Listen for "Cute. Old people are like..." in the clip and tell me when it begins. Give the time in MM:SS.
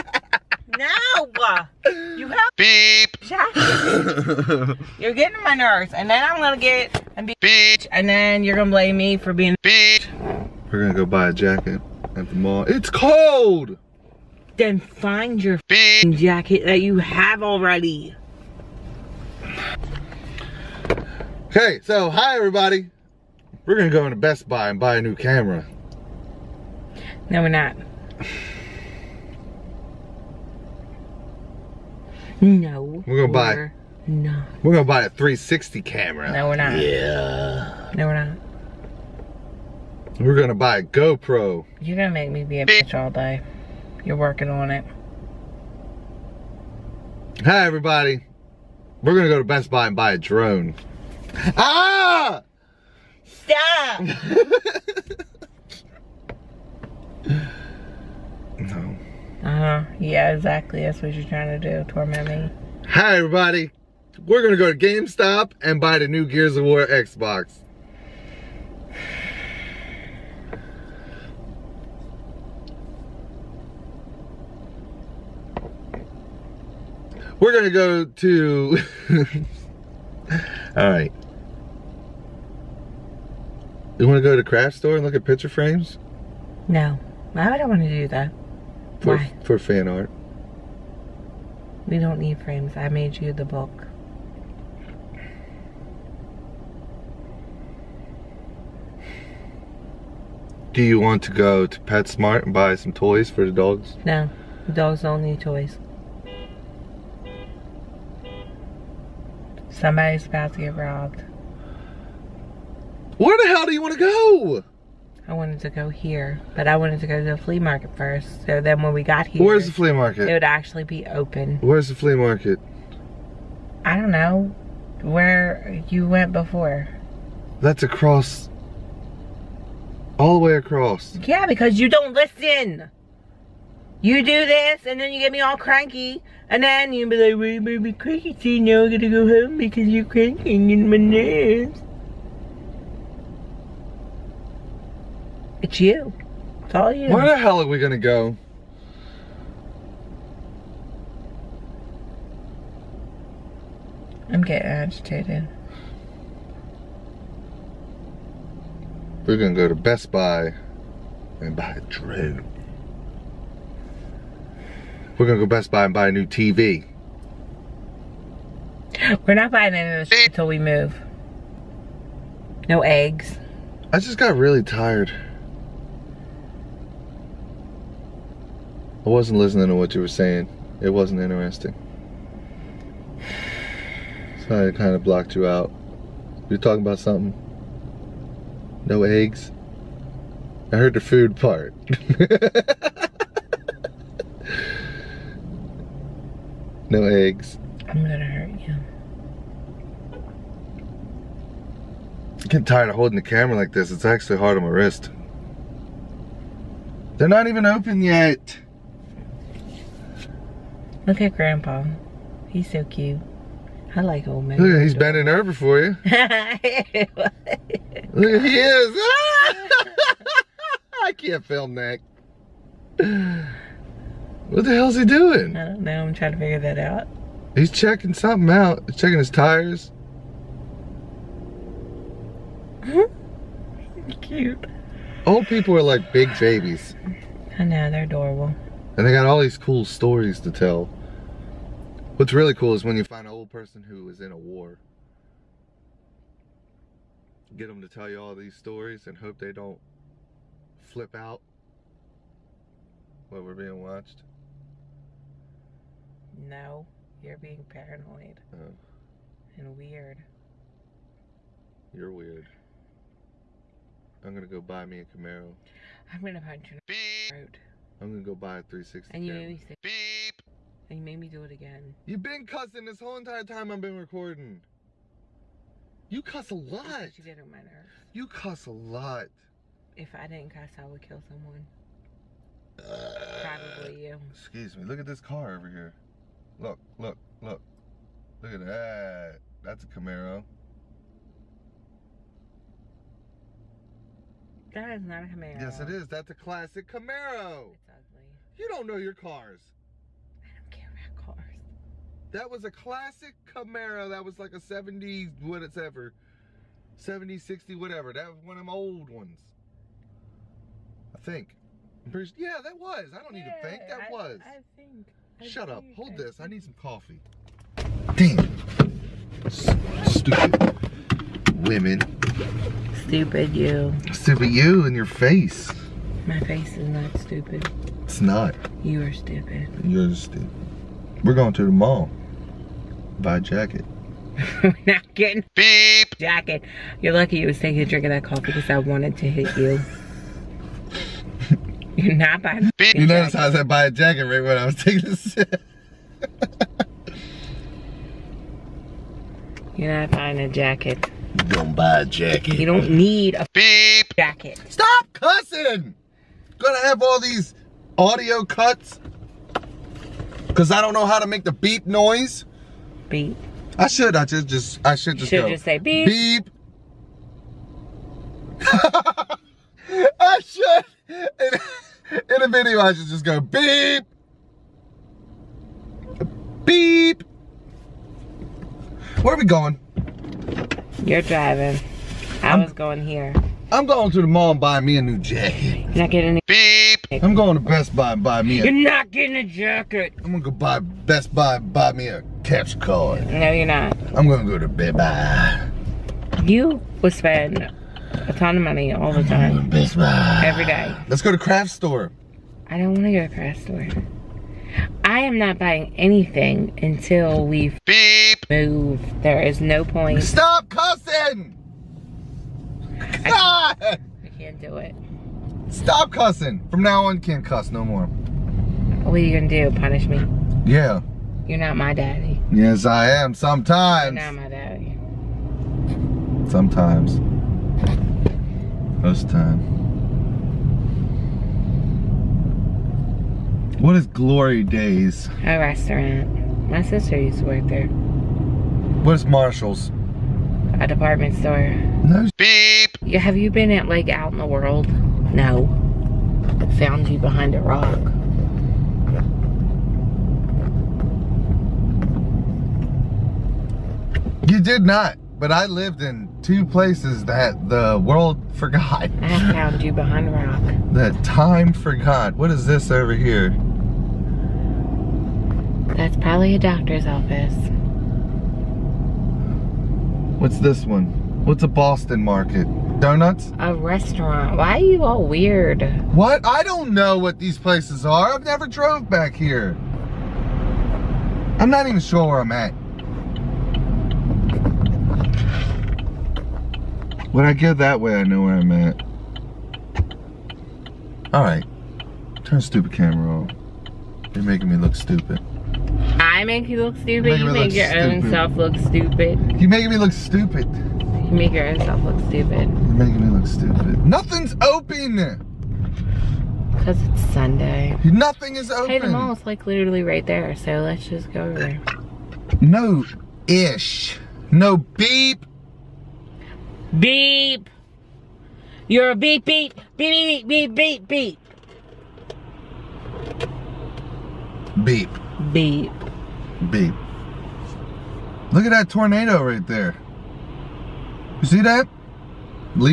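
03:54.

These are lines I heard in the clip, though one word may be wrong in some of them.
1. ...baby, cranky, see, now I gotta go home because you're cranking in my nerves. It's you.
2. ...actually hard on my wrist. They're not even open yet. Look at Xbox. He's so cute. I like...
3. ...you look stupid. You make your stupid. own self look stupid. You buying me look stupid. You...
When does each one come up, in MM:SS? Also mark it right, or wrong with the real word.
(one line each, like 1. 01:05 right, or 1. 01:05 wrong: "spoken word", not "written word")
1. 02:17 right
2. 03:24 wrong: "Grandpa", not "Xbox"
3. 08:16 wrong: "making", not "buying".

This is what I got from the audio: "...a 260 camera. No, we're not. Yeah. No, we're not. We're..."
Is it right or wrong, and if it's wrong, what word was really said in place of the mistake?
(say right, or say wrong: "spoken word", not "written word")
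wrong: "360", not "260".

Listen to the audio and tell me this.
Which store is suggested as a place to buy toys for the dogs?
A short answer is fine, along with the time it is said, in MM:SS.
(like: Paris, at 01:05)
PetSmart, at 01:41.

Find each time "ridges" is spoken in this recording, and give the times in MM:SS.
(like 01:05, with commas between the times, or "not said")
not said.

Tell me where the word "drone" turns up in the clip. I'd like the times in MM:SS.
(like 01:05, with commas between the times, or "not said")
00:50, 02:41.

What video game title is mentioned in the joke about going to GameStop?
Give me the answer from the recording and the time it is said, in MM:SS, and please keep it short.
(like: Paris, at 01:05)
Gears of War, at 01:06.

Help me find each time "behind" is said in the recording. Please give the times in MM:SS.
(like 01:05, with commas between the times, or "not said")
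07:27, 07:39.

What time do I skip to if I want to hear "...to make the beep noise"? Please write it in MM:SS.
06:01.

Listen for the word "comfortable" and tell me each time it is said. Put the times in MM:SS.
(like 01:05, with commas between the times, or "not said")
not said.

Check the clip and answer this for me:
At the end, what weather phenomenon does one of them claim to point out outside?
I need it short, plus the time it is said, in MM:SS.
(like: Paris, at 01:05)
Tornado, at 08:48.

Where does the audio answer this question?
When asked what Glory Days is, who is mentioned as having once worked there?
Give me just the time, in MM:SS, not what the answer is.
07:16.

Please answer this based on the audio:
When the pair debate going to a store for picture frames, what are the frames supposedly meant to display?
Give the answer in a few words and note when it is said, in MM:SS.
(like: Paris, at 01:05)
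Fan art, at 01:29.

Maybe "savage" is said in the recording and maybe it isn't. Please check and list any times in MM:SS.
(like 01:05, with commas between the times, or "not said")
not said.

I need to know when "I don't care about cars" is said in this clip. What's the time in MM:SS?
05:00.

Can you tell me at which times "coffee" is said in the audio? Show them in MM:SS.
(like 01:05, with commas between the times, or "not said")
05:16, 05:38.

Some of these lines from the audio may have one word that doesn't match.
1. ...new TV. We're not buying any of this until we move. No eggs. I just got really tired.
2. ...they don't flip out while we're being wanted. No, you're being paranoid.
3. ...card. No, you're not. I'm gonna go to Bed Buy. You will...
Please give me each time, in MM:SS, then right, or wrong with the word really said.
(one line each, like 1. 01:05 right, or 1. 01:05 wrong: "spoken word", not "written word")
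1. 02:46 right
2. 04:09 wrong: "watched", not "wanted"
3. 06:32 right.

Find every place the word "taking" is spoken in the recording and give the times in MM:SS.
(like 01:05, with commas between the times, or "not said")
05:37, 05:44.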